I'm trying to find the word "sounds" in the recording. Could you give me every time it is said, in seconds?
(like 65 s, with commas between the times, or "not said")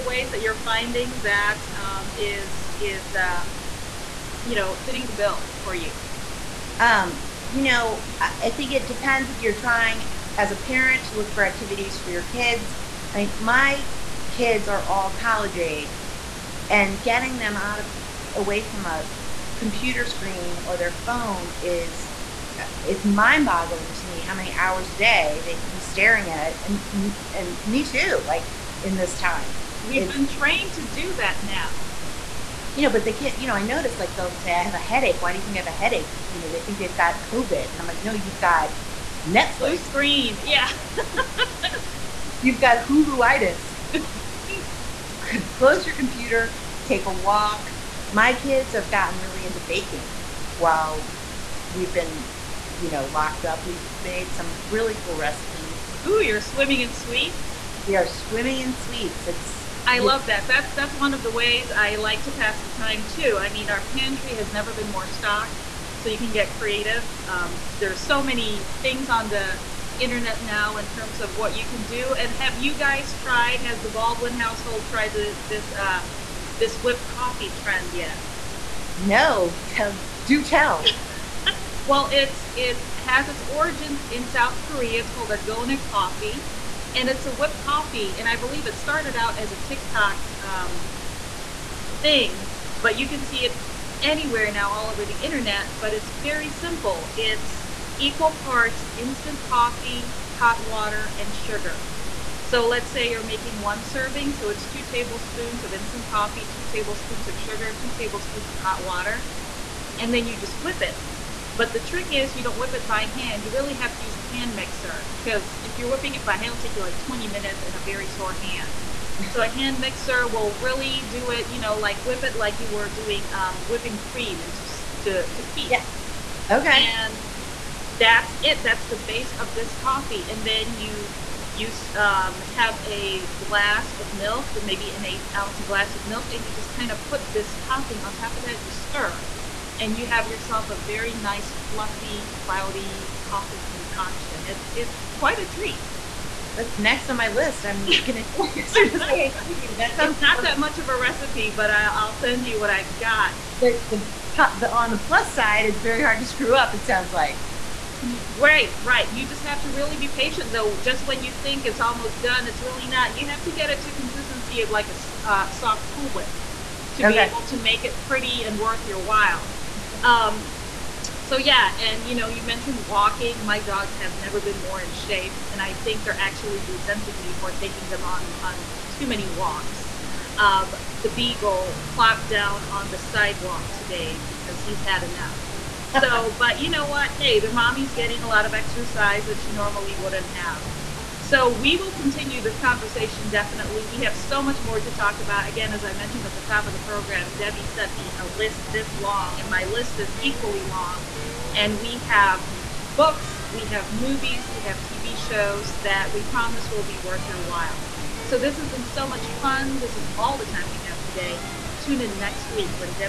149 s, 156 s.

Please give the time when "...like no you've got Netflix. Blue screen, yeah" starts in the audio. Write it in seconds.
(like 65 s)
37 s.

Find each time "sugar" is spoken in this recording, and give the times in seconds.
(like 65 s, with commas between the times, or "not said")
101 s, 107 s.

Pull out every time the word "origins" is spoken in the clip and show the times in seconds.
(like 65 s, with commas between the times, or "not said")
83 s.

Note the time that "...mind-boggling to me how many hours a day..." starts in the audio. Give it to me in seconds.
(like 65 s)
23 s.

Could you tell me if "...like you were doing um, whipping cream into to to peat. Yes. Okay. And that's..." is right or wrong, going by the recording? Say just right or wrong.
right.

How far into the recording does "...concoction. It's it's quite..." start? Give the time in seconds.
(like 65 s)
143 s.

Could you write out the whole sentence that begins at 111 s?
But the trick is you don't whip it by hand.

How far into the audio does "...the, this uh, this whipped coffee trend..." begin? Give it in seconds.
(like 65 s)
75 s.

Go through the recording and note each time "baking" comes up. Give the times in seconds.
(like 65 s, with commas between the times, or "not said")
49 s.